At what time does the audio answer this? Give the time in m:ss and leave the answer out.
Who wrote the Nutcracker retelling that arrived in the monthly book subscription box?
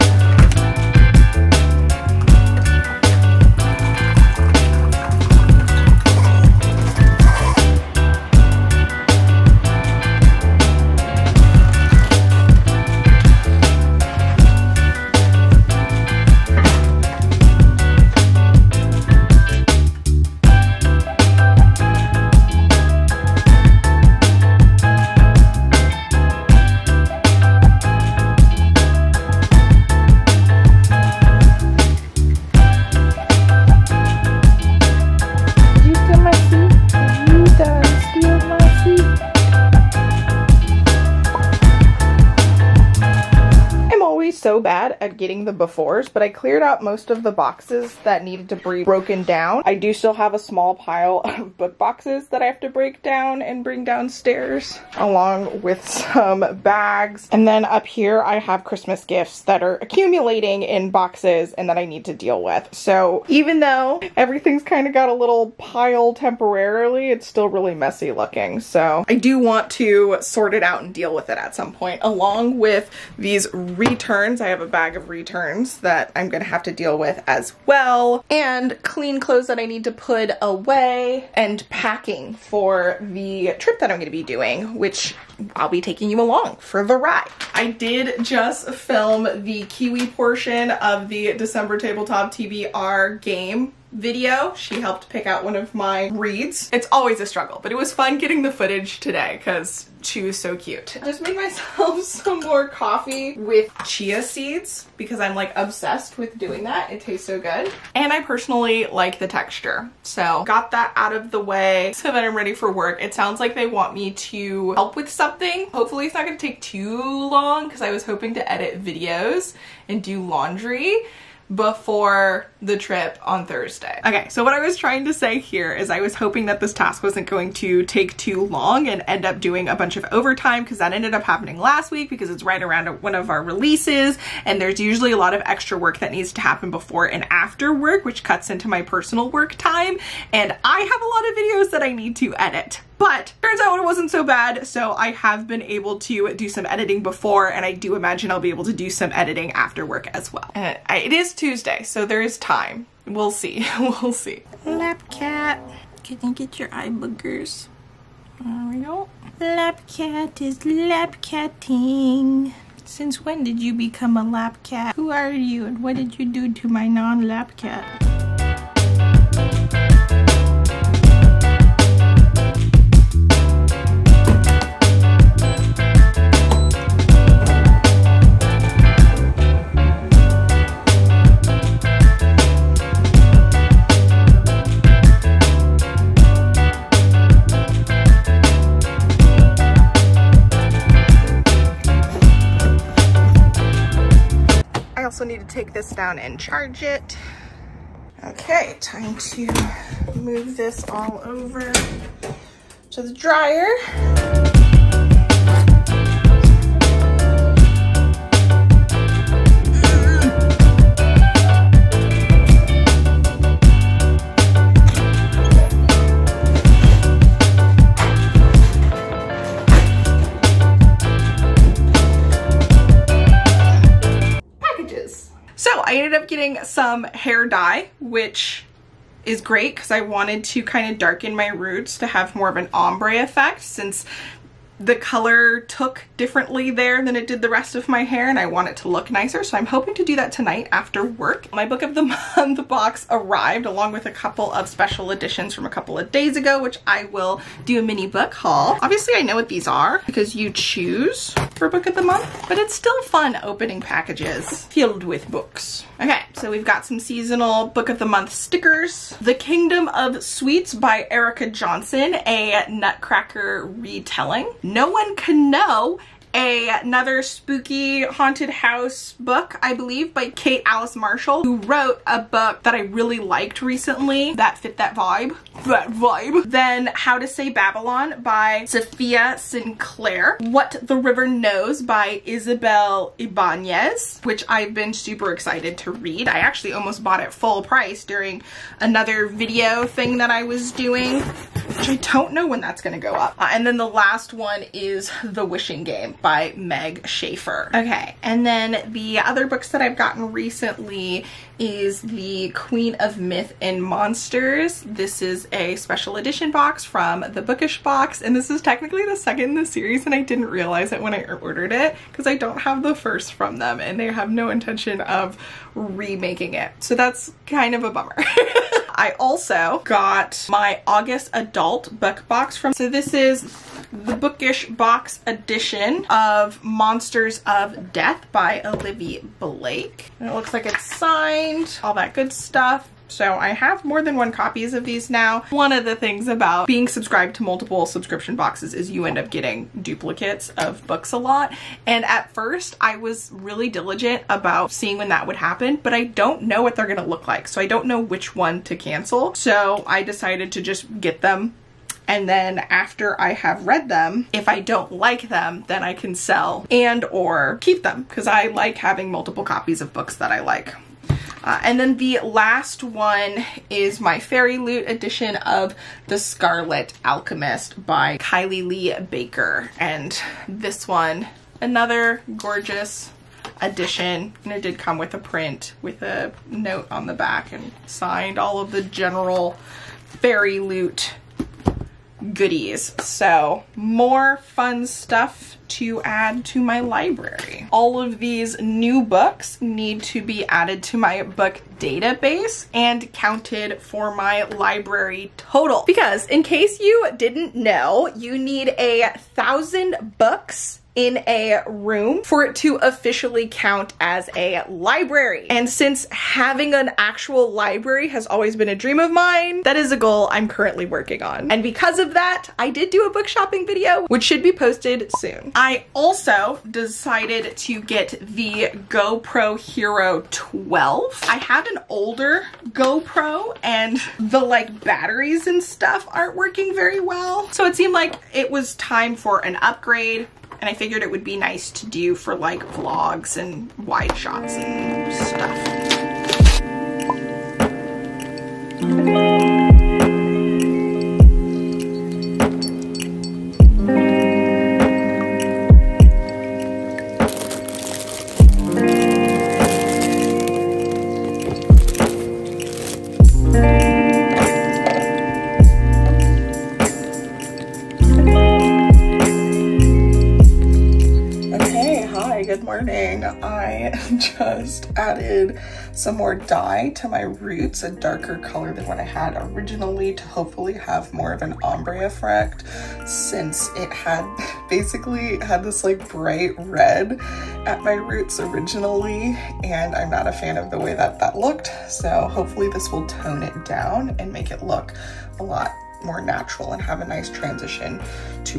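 4:21.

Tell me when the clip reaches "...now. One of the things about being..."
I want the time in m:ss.
5:35.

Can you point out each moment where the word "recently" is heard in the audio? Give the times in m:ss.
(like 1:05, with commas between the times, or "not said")
4:33, 5:00.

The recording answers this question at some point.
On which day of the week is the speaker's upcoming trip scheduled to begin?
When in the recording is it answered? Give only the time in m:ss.
2:03.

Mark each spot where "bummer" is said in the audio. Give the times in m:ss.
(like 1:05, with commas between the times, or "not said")
5:17.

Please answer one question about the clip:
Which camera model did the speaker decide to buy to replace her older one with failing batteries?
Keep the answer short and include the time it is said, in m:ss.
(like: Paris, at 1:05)
GoPro Hero 12, at 6:58.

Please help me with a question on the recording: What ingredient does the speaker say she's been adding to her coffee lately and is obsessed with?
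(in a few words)
chia seeds.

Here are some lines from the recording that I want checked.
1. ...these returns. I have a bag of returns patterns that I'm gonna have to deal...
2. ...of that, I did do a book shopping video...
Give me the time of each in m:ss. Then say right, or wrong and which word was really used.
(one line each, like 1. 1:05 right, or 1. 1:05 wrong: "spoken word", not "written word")
1. 1:13 right
2. 6:51 right.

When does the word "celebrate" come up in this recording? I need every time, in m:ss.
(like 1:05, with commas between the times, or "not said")
not said.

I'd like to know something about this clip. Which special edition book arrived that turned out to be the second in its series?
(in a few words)
The Queen of Myth and Monsters.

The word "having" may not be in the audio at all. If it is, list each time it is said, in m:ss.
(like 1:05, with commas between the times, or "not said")
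5:58, 6:46.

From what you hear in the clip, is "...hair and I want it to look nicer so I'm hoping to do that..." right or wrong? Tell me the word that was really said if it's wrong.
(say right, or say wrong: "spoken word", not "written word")
right.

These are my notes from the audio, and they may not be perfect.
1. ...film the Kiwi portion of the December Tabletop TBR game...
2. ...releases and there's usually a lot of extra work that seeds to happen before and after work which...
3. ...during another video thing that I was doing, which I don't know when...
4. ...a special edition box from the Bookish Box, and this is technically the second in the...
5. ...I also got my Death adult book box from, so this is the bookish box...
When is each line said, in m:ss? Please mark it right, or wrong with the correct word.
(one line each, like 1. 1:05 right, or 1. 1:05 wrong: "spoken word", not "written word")
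1. 1:28 right
2. 2:13 wrong: "needs", not "seeds"
3. 4:48 right
4. 5:05 right
5. 5:18 wrong: "August", not "Death".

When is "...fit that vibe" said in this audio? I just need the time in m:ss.
4:34.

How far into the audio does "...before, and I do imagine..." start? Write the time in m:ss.
2:27.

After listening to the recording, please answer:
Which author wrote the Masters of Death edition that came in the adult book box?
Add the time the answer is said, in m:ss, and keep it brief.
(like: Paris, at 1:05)
Olivia Blake, at 5:28.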